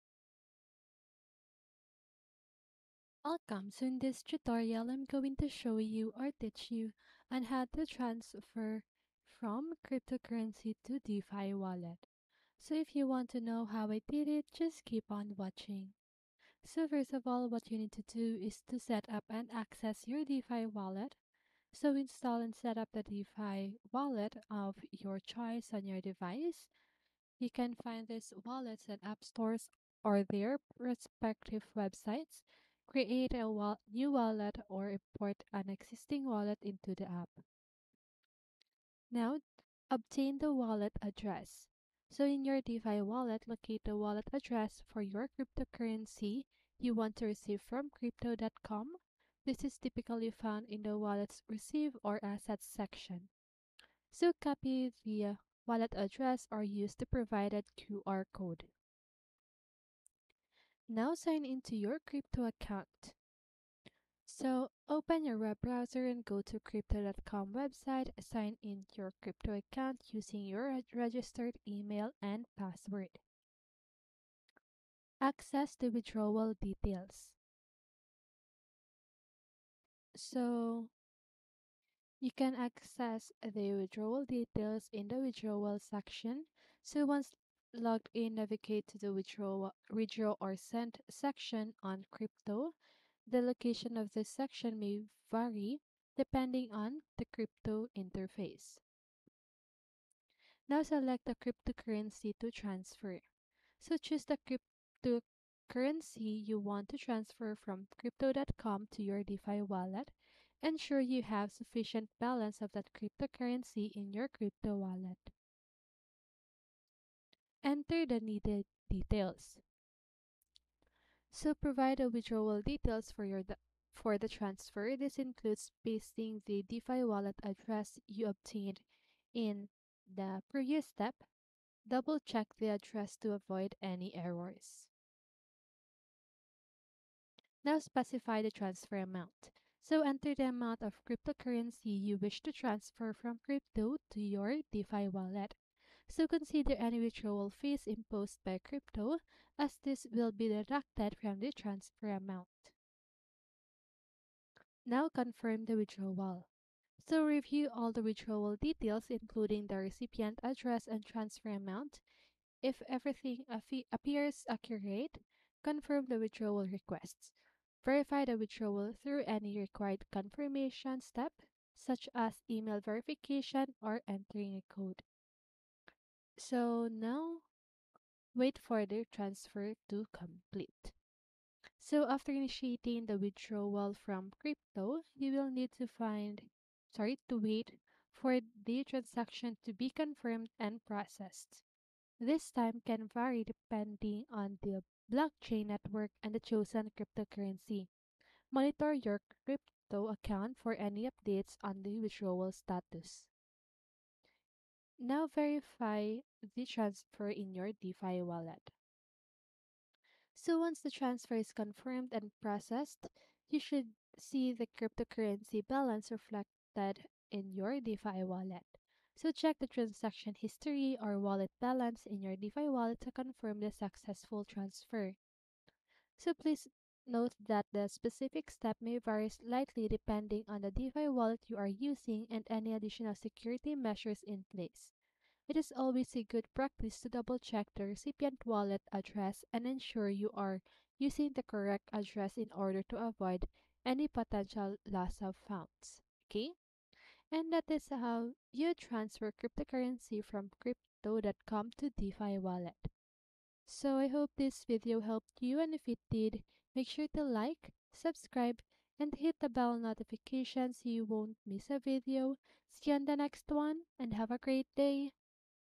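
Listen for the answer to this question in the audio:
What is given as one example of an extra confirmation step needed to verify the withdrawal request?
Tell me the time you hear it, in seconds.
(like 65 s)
172 s.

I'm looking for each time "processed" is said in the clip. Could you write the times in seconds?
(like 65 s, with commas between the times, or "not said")
190 s, 212 s.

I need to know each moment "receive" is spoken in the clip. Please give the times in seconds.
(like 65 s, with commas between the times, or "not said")
47 s, 51 s.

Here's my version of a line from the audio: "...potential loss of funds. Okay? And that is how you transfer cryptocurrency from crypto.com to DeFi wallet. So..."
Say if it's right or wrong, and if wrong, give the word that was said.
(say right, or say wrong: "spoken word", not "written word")
right.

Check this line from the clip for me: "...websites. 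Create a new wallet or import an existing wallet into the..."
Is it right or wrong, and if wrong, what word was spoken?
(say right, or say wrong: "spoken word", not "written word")
right.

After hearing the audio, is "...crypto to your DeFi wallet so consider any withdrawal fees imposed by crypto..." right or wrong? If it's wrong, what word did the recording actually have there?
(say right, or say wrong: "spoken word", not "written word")
right.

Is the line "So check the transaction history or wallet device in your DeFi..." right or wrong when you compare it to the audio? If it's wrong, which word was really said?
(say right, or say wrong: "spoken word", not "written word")
wrong: "balance", not "device".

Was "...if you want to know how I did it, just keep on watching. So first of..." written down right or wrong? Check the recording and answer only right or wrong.
right.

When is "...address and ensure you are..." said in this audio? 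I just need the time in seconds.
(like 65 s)
238 s.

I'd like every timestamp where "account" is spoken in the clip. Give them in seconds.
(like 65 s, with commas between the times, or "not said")
62 s, 69 s, 200 s.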